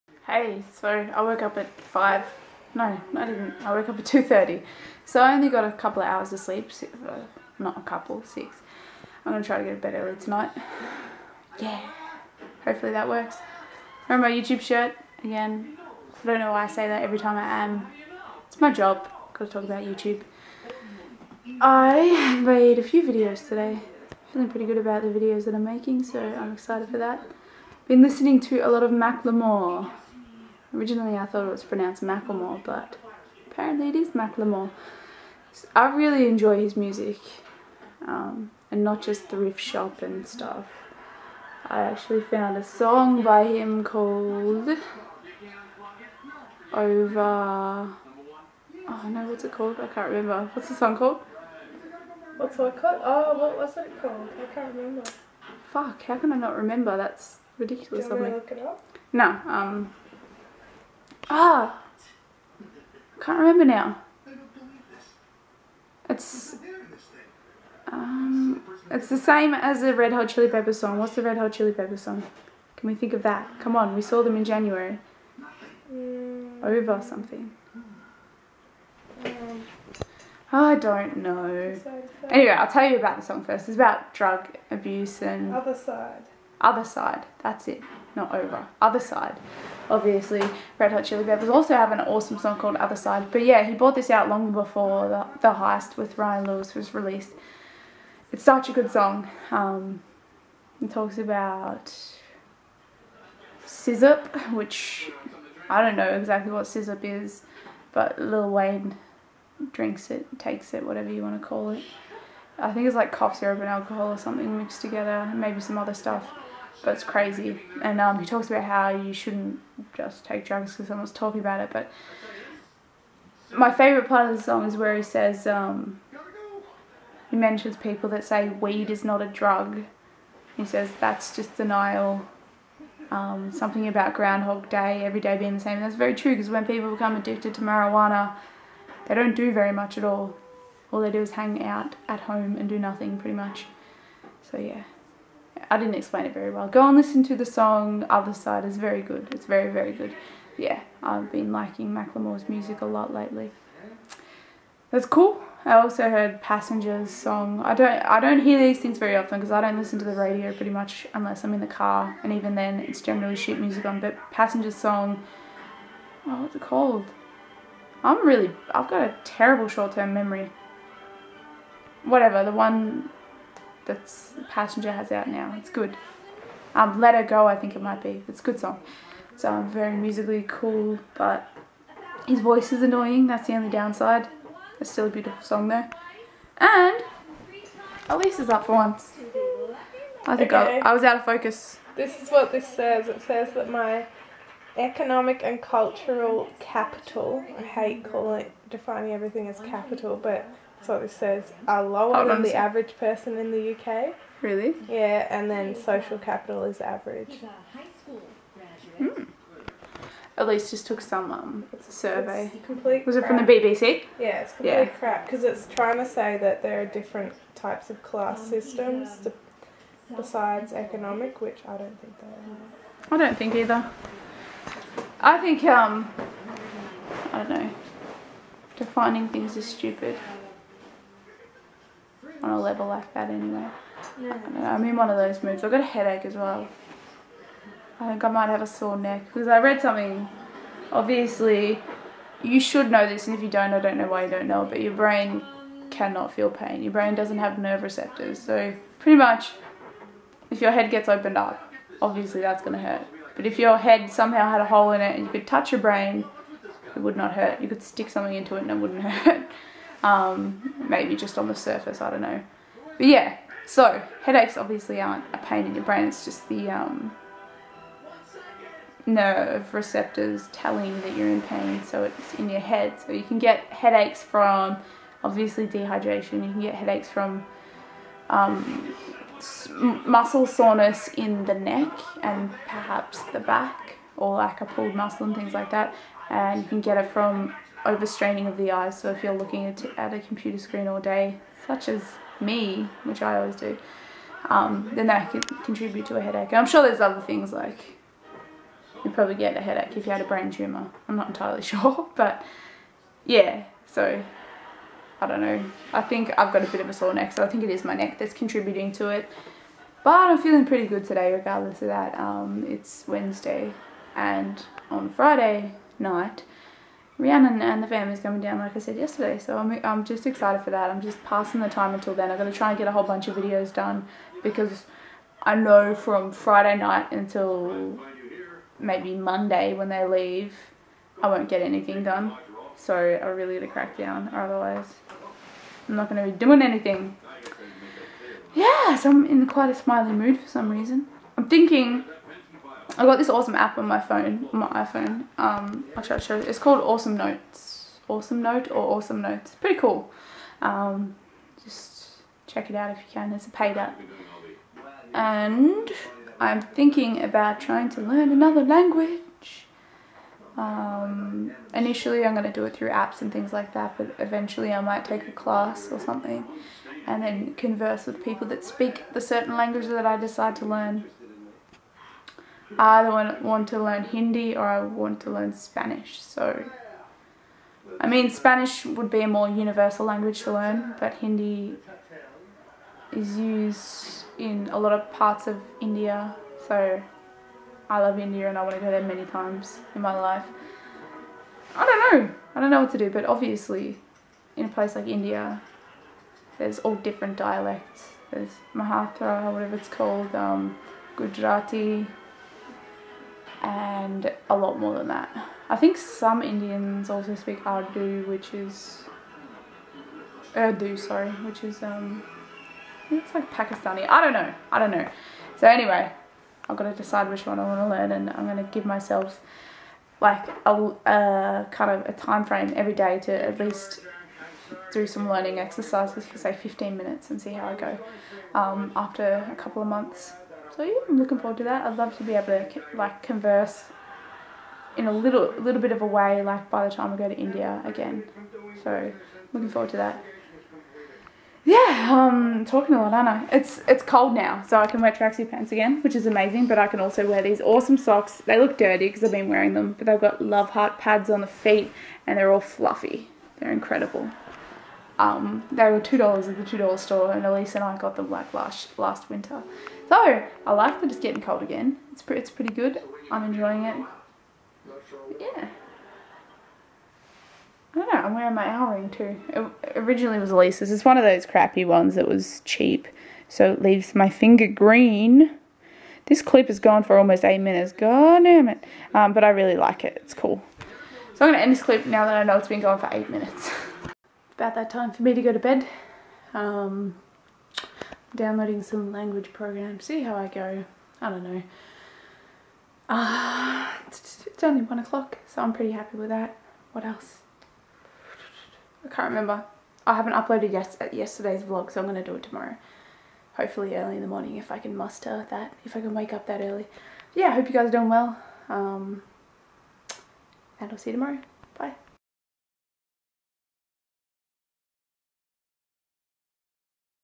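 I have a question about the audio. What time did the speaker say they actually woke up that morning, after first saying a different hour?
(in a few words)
2:30.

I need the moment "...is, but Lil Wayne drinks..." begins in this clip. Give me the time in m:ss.
1:47.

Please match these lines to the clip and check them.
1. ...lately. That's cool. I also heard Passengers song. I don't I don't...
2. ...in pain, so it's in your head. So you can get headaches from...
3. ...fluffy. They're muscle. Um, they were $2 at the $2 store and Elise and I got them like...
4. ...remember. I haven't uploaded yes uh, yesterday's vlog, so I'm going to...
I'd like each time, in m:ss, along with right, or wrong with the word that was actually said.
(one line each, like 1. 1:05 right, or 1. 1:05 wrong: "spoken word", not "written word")
1. 2:33 right
2. 4:31 right
3. 7:32 wrong: "incredible", not "muscle"
4. 8:19 right.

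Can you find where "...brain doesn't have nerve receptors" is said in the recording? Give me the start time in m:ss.
4:06.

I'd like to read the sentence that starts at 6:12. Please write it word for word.
I want, want to learn Hindi or I want to learn Spanish.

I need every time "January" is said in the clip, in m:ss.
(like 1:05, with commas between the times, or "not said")
1:14.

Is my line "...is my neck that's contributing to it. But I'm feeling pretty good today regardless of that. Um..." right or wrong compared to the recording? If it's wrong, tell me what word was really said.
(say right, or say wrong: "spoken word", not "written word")
right.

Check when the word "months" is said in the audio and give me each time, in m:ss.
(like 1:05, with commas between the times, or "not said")
7:09.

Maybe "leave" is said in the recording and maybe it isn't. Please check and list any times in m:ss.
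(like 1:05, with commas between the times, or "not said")
5:30, 7:53.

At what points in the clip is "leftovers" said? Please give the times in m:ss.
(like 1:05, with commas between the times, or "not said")
not said.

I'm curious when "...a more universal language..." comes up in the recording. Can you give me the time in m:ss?
6:19.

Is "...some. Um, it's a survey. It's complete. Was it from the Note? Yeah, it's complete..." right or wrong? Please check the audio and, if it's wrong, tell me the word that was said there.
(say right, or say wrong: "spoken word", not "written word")
wrong: "BBC", not "Note".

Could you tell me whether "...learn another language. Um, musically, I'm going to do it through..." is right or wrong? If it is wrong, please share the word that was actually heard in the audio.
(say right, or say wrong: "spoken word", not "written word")
wrong: "initially", not "musically".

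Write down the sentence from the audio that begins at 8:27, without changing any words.
yeah, I hope you guys are doing well.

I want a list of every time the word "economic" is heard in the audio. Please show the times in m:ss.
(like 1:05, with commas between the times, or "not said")
3:14, 3:40.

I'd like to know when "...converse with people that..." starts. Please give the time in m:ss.
6:07.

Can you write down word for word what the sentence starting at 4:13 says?
But if your head somehow had a hole in it and you could touch your brain, it would not hurt.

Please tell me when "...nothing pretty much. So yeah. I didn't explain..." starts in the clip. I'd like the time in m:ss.
2:22.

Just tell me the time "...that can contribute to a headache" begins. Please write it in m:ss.
4:55.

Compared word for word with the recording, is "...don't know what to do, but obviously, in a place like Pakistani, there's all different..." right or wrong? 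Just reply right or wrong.
wrong.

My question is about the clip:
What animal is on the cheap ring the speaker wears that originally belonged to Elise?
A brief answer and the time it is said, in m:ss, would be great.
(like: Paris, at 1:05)
owl, at 7:48.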